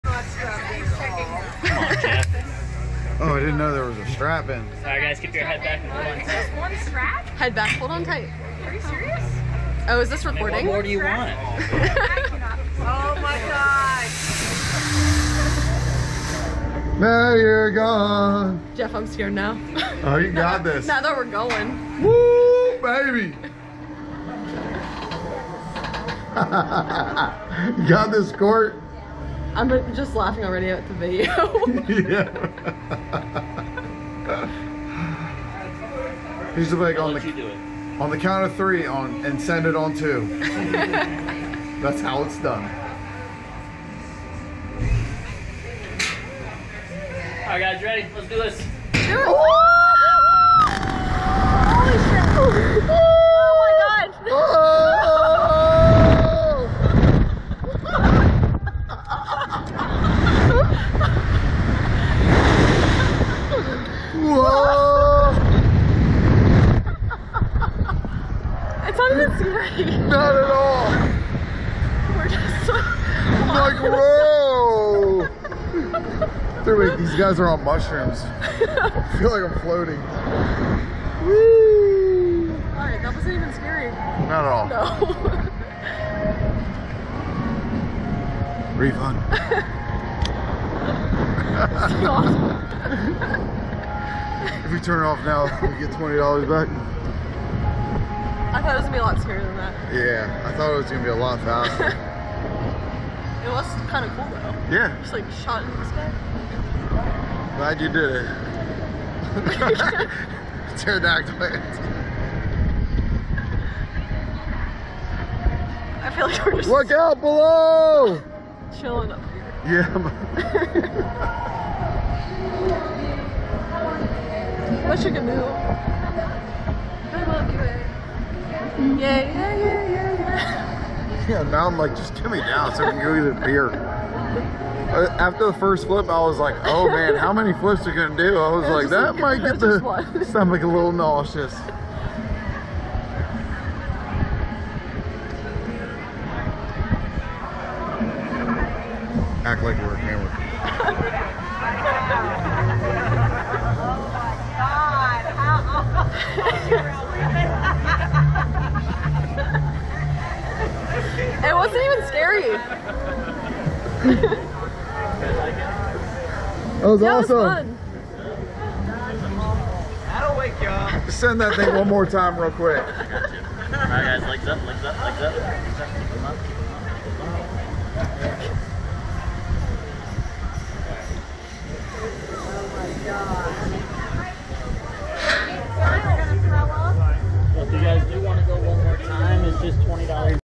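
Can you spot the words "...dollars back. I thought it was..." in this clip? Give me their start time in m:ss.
1:36.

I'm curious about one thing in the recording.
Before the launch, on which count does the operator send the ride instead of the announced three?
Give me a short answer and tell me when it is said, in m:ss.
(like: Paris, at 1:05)
2, at 0:39.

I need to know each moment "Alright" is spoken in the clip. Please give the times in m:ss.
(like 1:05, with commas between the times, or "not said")
0:04, 1:22, 2:52.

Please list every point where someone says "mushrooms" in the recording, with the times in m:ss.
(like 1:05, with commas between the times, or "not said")
1:17.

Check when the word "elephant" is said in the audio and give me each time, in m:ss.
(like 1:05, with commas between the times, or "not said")
not said.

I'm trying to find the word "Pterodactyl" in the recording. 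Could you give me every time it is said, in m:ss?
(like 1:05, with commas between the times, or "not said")
1:50.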